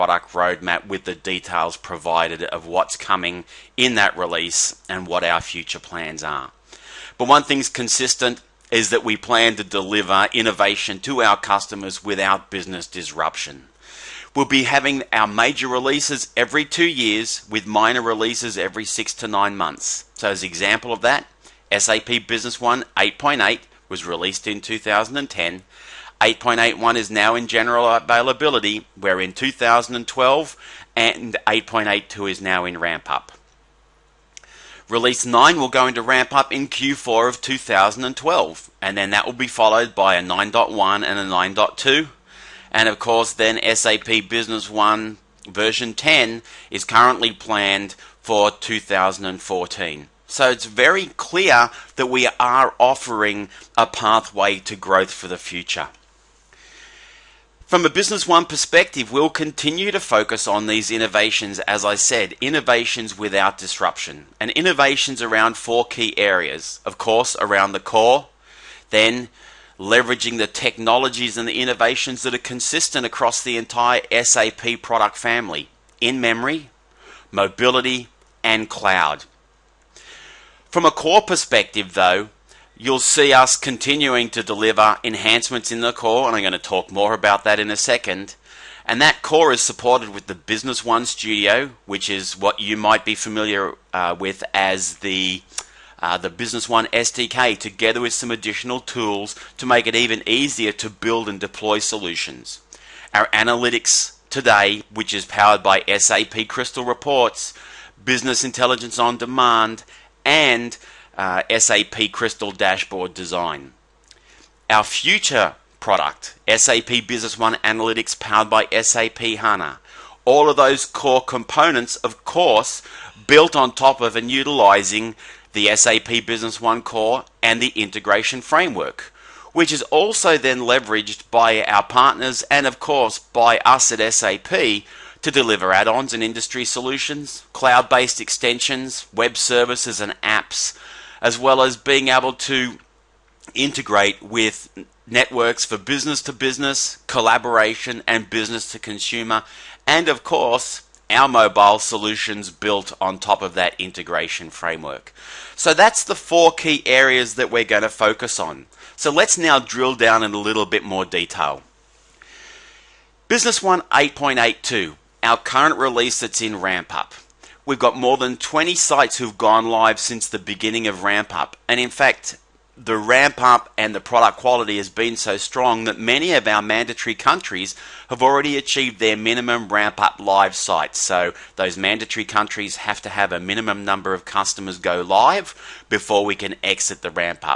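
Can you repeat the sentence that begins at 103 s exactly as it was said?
Our analytics today, which is powered by SAP Crystal Reports, Business Intelligence on Demand, and uh, SAP Crystal Dashboard Design.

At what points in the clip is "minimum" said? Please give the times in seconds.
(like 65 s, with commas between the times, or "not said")
179 s, 183 s.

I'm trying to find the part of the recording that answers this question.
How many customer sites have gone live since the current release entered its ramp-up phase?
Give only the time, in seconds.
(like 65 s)
167 s.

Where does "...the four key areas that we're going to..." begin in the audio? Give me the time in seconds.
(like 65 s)
156 s.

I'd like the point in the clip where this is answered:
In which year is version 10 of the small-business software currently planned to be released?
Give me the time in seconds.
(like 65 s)
48 s.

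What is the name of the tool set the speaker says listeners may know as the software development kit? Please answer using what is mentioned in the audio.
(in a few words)
Business One Studio.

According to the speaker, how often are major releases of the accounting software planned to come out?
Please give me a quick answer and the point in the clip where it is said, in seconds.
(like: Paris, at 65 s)
every two years, at 16 s.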